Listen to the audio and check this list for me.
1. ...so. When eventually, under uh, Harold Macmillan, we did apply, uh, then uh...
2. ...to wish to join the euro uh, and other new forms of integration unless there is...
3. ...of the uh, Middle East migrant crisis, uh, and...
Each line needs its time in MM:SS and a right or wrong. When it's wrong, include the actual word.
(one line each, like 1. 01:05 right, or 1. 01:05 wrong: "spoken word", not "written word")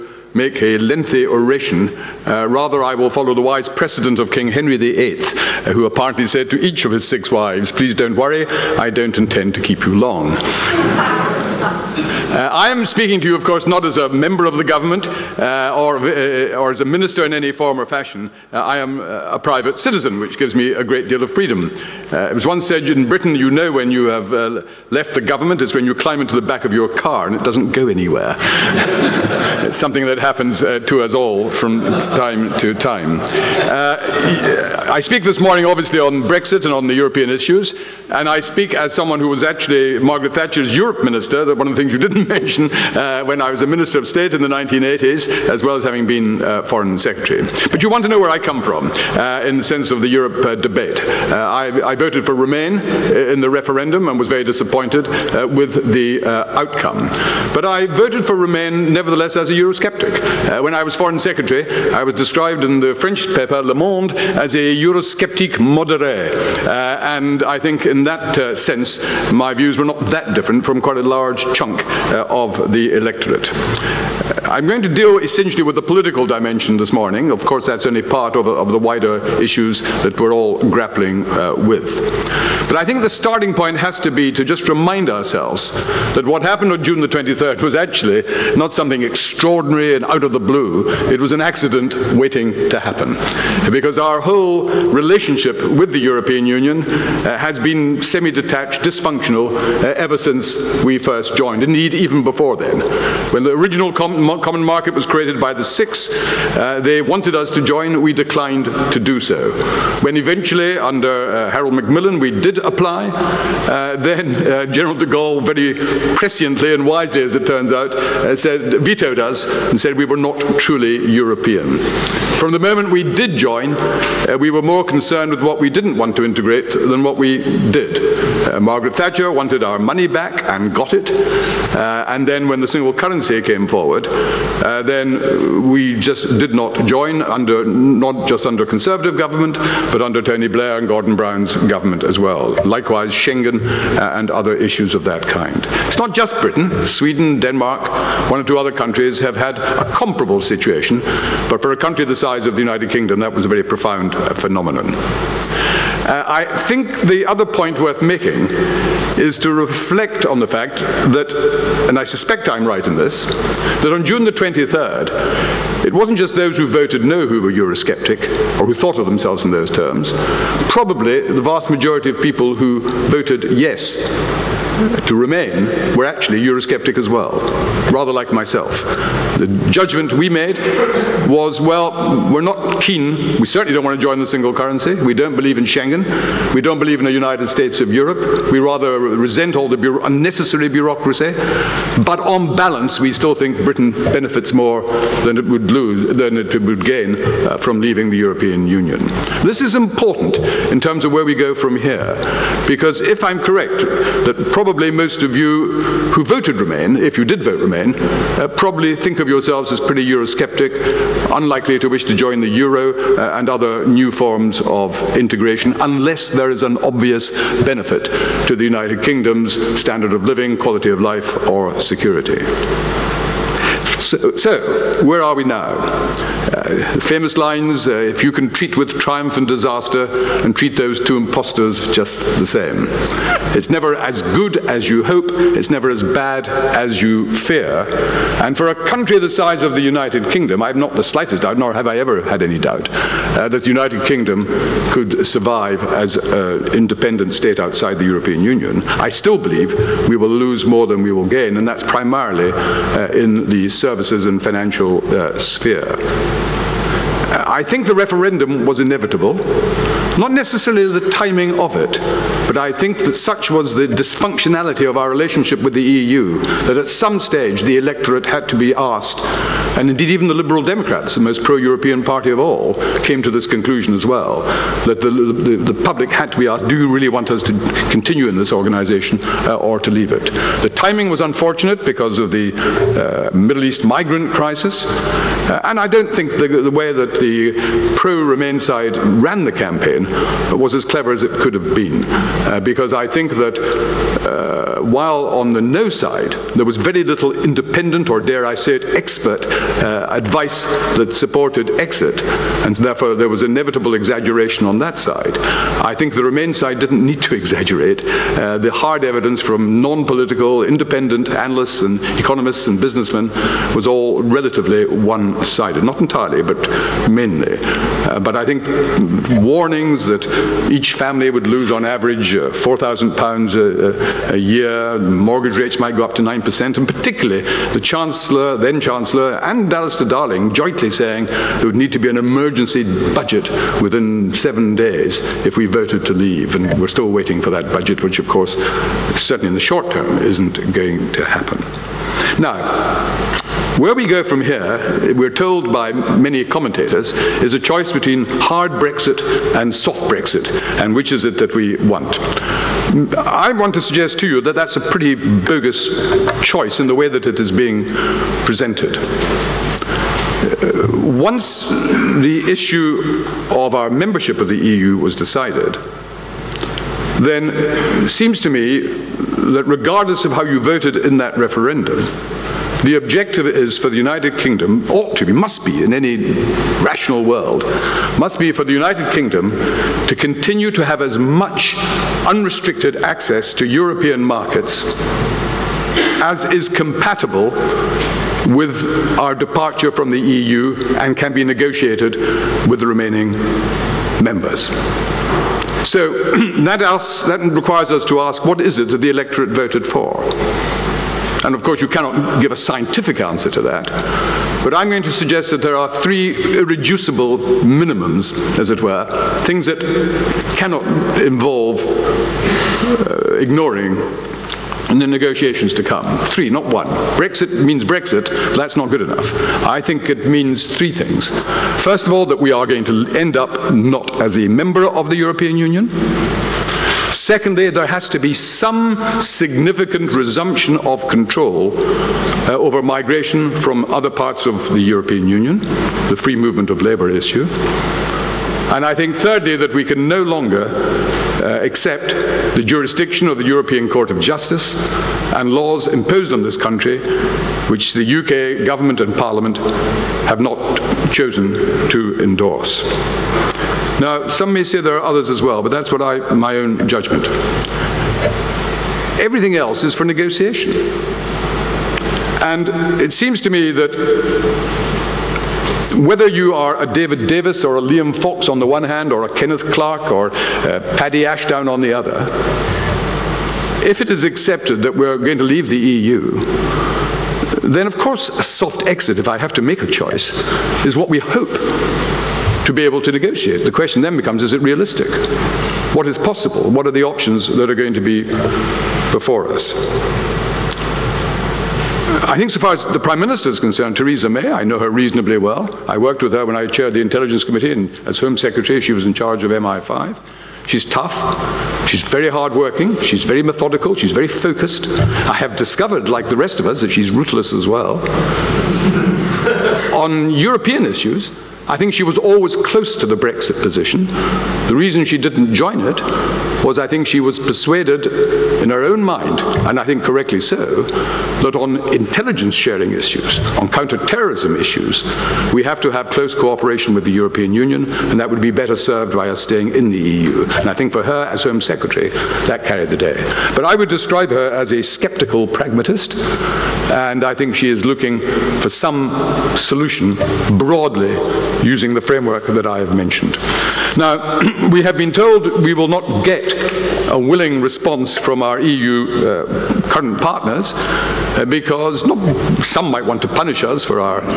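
1. 01:49 right
2. 03:31 right
3. 04:42 right.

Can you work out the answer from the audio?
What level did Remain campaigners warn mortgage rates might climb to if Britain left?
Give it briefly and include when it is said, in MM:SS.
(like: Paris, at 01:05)
9%, at 05:26.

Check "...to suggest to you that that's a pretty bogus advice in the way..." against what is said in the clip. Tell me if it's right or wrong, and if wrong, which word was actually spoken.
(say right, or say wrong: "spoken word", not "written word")
wrong: "choice", not "advice".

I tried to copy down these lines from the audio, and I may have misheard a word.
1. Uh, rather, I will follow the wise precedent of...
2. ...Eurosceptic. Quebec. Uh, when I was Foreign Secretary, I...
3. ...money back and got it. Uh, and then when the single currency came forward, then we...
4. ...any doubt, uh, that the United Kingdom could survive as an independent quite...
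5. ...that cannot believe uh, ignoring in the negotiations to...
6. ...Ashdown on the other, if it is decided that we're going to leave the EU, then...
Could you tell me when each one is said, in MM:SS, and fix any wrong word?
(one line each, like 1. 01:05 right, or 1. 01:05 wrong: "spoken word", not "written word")
1. 00:02 right
2. 00:59 right
3. 02:09 right
4. 04:02 wrong: "state", not "quite"
5. 06:49 wrong: "involve", not "believe"
6. 07:51 wrong: "accepted", not "decided".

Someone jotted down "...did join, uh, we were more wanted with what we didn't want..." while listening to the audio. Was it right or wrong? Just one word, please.
wrong.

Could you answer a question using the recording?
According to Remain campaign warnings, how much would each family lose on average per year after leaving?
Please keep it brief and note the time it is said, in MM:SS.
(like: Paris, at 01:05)
4,000 pounds, at 05:22.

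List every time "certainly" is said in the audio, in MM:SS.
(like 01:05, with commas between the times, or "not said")
03:03, 05:39.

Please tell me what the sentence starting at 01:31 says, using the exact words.
It was an accident waiting to happen.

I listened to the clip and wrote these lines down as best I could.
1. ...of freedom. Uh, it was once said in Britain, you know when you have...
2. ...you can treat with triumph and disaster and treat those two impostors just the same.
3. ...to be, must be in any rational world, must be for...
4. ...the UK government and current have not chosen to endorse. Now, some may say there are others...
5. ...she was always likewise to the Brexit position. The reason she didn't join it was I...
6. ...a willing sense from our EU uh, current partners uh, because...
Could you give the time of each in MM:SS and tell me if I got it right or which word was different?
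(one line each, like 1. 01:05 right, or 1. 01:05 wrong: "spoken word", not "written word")
1. 00:21 right
2. 03:48 right
3. 06:15 right
4. 07:27 wrong: "parliament", not "current"
5. 08:31 wrong: "close", not "likewise"
6. 09:07 wrong: "response", not "sense".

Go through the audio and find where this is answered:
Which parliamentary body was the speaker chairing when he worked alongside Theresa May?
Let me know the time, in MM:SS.
08:17.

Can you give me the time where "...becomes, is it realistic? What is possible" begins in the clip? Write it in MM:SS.
08:04.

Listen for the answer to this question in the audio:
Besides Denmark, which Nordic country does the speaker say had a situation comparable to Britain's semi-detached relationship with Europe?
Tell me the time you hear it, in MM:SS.
02:26.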